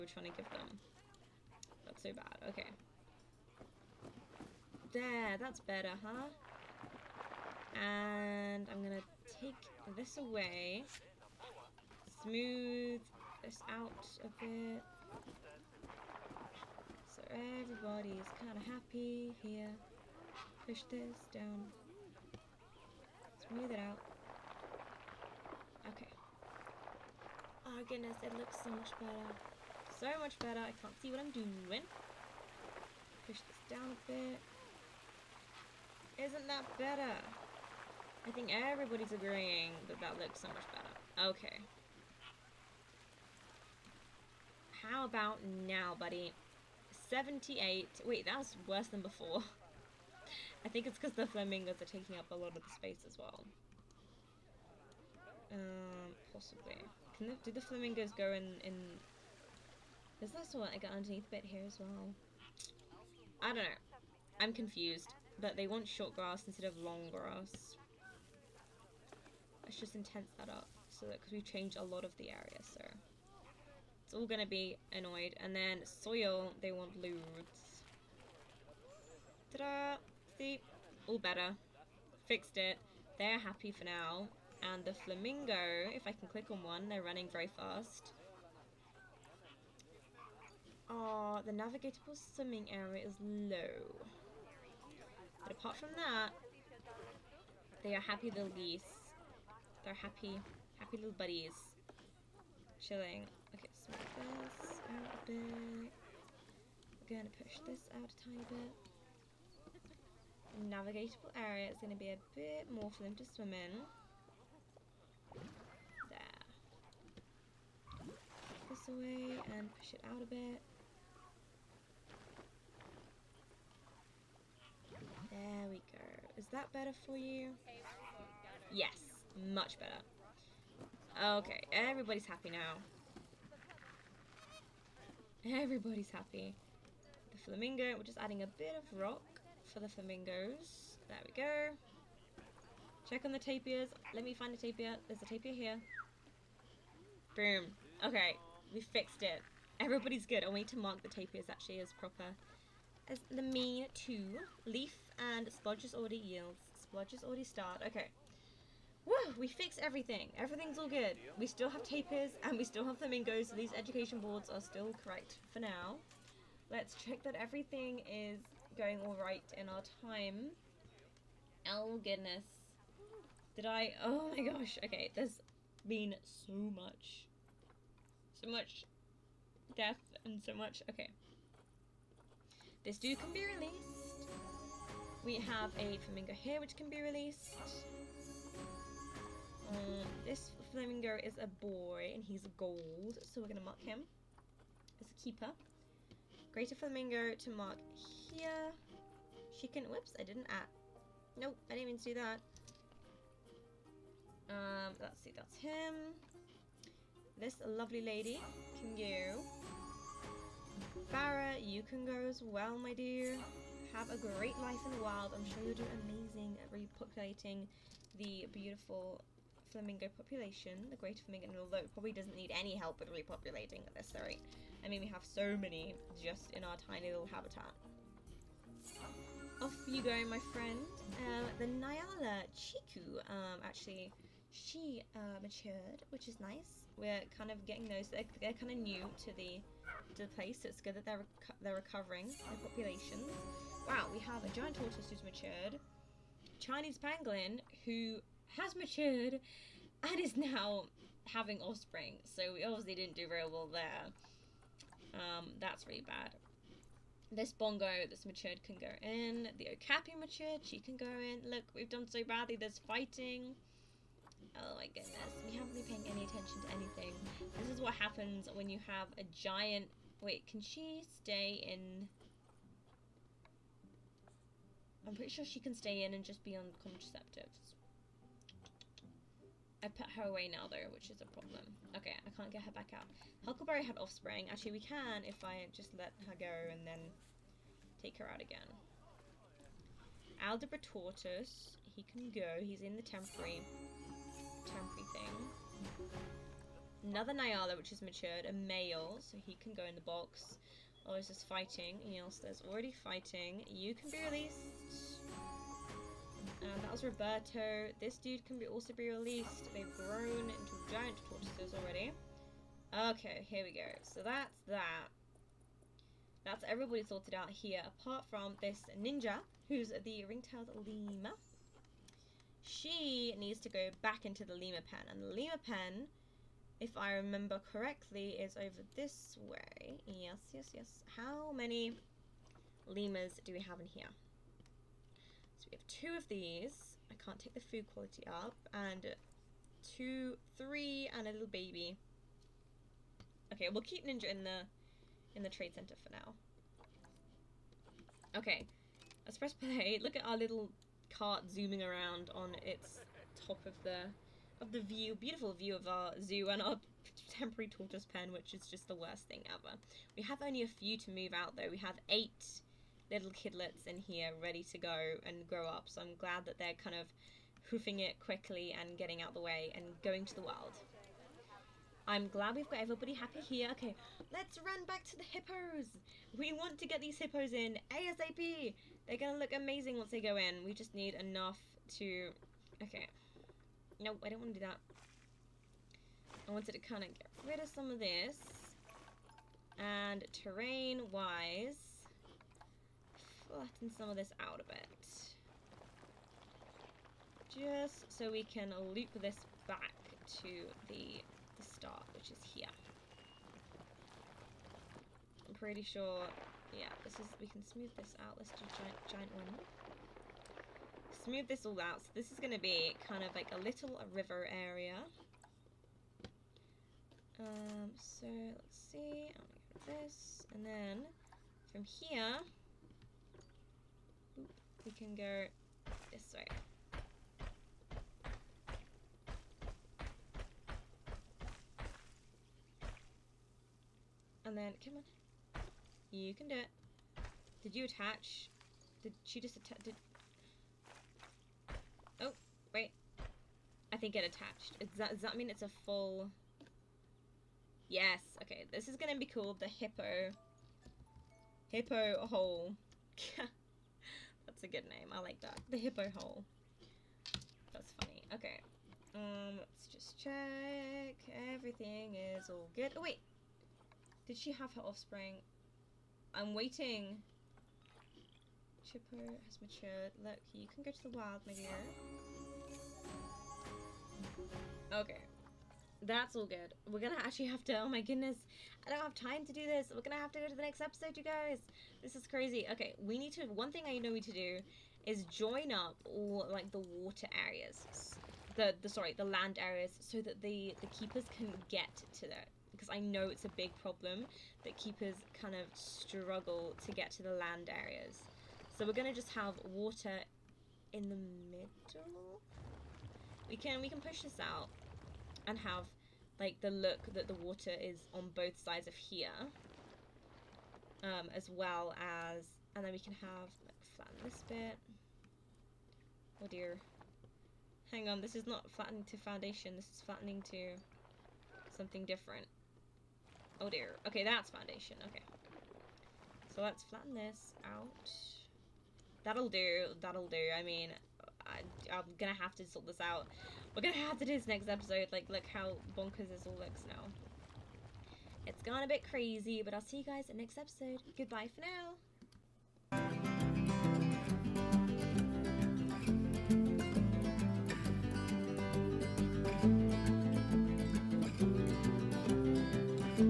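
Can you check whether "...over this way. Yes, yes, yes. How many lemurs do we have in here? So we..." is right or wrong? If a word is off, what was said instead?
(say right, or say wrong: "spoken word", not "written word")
right.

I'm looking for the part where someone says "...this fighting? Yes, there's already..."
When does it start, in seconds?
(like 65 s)
301 s.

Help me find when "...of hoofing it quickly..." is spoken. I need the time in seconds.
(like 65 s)
366 s.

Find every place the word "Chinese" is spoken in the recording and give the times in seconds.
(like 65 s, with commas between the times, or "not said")
246 s.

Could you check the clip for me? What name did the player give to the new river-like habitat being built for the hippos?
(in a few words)
The hippo hole.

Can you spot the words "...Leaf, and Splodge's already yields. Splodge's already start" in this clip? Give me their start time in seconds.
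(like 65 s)
154 s.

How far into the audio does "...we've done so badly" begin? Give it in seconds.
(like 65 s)
261 s.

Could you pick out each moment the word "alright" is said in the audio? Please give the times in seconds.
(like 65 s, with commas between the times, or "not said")
169 s.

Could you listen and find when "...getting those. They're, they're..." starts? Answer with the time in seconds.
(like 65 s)
237 s.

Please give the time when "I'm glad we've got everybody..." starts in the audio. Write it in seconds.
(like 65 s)
372 s.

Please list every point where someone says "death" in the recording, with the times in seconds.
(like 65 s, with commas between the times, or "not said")
179 s.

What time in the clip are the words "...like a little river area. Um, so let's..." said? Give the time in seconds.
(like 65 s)
413 s.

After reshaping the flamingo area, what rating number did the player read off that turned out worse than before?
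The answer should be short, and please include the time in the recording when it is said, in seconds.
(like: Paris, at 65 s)
78, at 47 s.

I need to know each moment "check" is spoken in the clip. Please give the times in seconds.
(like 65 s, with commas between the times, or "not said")
143 s, 166 s, 460 s.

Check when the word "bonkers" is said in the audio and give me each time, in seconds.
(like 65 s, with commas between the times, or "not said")
535 s.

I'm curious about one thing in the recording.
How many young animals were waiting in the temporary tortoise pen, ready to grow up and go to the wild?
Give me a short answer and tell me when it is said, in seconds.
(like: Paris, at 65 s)
8, at 362 s.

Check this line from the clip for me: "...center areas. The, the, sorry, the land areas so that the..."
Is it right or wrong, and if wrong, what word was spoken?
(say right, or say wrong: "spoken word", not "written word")
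wrong: "water", not "center".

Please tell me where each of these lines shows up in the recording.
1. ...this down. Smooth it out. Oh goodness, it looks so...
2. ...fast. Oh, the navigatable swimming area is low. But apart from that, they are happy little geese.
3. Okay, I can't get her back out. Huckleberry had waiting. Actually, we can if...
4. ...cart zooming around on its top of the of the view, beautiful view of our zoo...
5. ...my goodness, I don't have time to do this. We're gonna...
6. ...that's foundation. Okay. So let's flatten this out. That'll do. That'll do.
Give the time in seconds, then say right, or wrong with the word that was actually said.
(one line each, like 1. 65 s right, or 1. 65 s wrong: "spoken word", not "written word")
1. 20 s right
2. 87 s right
3. 281 s wrong: "offspring", not "waiting"
4. 351 s right
5. 477 s right
6. 524 s right.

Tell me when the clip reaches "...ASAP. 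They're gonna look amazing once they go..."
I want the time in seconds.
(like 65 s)
377 s.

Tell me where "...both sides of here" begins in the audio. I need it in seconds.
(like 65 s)
508 s.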